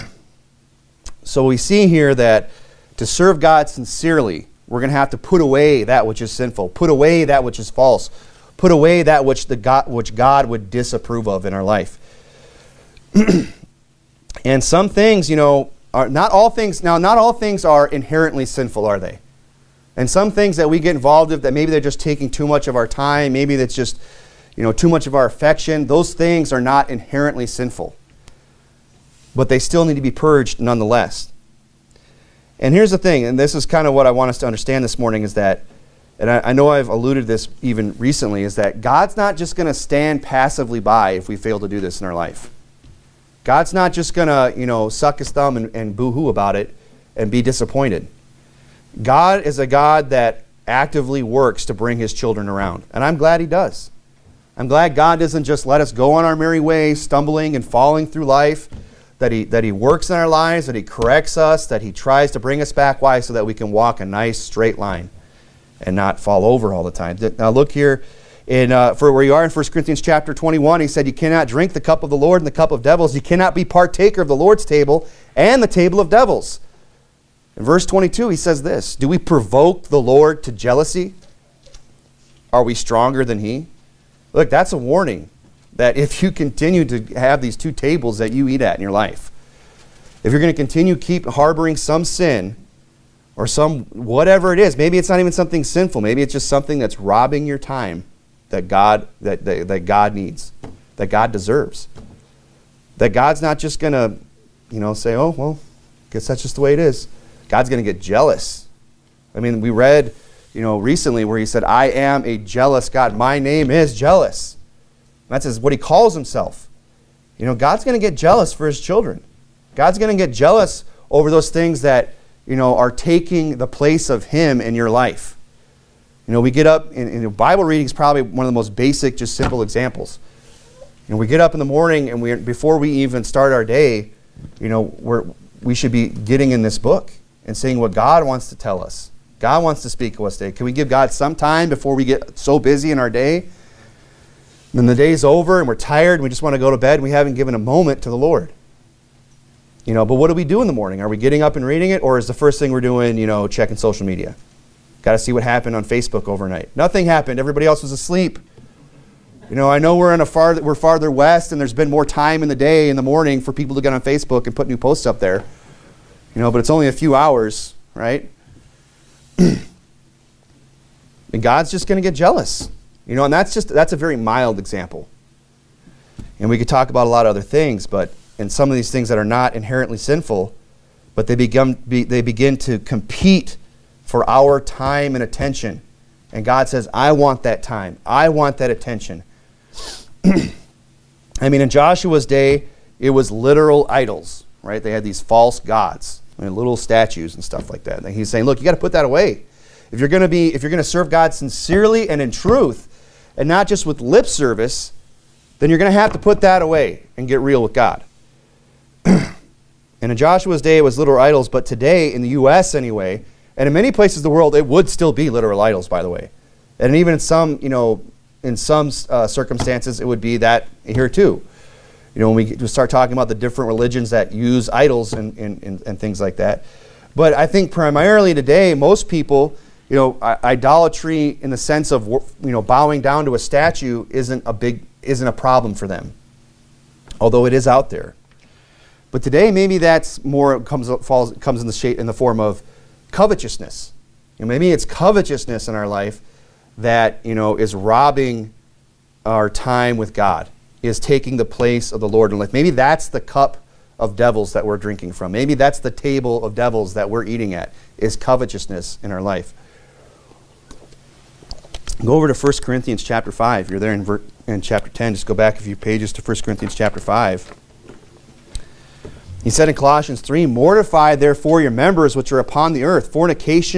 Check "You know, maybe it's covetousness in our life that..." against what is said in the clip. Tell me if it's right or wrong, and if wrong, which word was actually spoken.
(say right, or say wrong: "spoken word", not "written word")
right.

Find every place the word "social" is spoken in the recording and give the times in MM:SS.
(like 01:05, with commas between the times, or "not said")
02:33.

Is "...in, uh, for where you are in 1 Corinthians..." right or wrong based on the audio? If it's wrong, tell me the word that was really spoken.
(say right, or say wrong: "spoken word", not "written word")
right.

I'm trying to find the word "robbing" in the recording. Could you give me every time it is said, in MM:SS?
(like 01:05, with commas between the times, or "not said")
01:36, 04:07.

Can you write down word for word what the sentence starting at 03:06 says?
And God says, "I want that time.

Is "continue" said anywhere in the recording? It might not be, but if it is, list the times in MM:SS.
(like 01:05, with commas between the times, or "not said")
01:26, 01:30.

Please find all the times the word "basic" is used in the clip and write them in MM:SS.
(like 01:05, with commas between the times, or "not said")
02:08.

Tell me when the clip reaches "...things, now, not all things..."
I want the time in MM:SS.
00:16.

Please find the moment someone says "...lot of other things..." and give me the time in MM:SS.
02:57.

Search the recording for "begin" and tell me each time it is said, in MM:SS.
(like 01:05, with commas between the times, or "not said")
03:02.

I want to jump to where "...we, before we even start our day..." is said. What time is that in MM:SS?
02:12.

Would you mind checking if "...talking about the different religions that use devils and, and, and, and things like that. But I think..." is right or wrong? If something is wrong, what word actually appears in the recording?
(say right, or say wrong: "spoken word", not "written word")
wrong: "idols", not "devils".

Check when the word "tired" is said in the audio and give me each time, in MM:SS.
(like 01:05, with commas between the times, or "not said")
02:25.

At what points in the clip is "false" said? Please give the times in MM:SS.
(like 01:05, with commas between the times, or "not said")
00:07, 03:15.